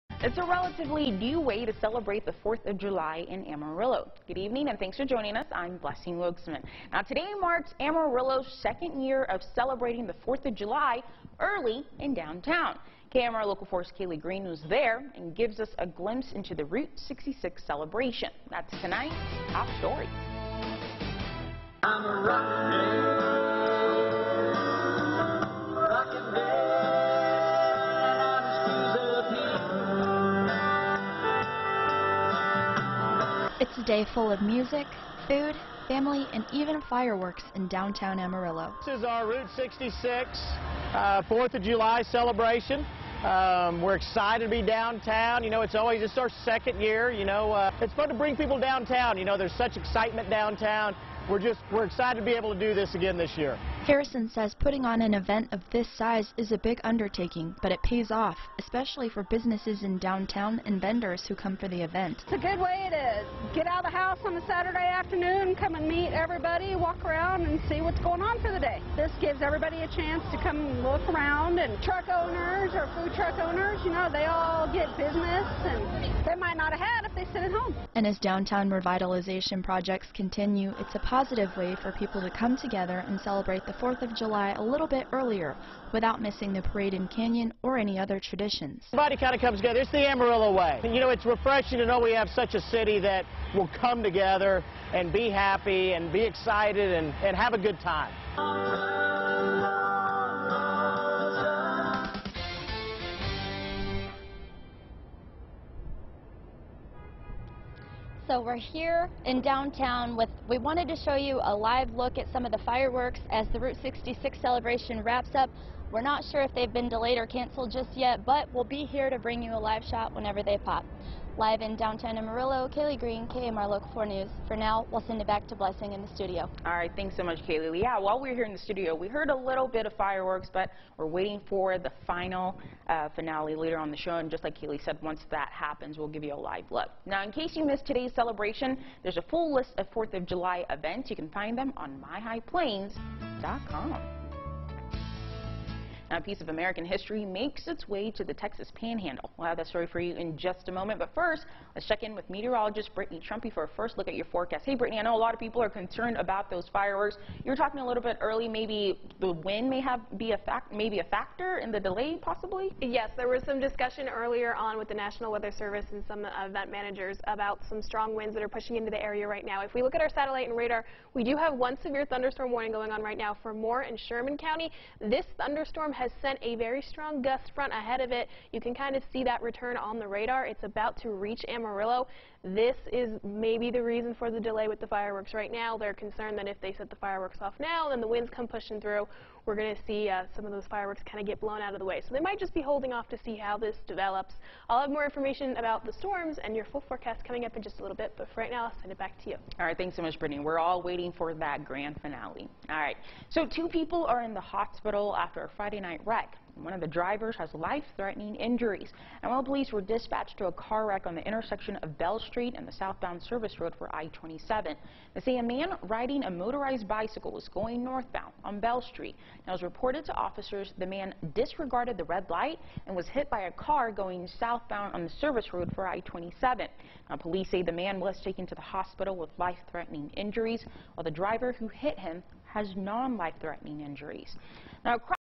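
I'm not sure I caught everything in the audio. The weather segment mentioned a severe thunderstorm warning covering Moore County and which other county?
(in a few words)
Sherman County.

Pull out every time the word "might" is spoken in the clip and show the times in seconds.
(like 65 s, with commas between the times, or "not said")
76 s, 192 s.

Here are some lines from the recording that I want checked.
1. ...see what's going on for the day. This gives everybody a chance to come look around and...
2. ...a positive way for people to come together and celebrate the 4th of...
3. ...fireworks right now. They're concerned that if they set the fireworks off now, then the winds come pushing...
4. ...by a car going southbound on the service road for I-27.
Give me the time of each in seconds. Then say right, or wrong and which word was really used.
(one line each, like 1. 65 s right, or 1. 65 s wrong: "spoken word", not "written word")
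1. 67 s right
2. 80 s right
3. 184 s right
4. 223 s right.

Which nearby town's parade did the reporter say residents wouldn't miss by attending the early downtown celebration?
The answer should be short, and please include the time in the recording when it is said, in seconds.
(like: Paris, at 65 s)
Canyon, at 87 s.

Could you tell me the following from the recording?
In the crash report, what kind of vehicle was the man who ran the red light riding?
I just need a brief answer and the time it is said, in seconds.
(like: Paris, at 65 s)
Motorized bicycle, at 216 s.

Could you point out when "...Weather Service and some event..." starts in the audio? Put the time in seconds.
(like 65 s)
165 s.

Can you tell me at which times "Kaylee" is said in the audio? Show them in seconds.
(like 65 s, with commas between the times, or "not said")
13 s, 122 s, 127 s, 134 s.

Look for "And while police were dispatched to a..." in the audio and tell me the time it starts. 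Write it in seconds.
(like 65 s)
209 s.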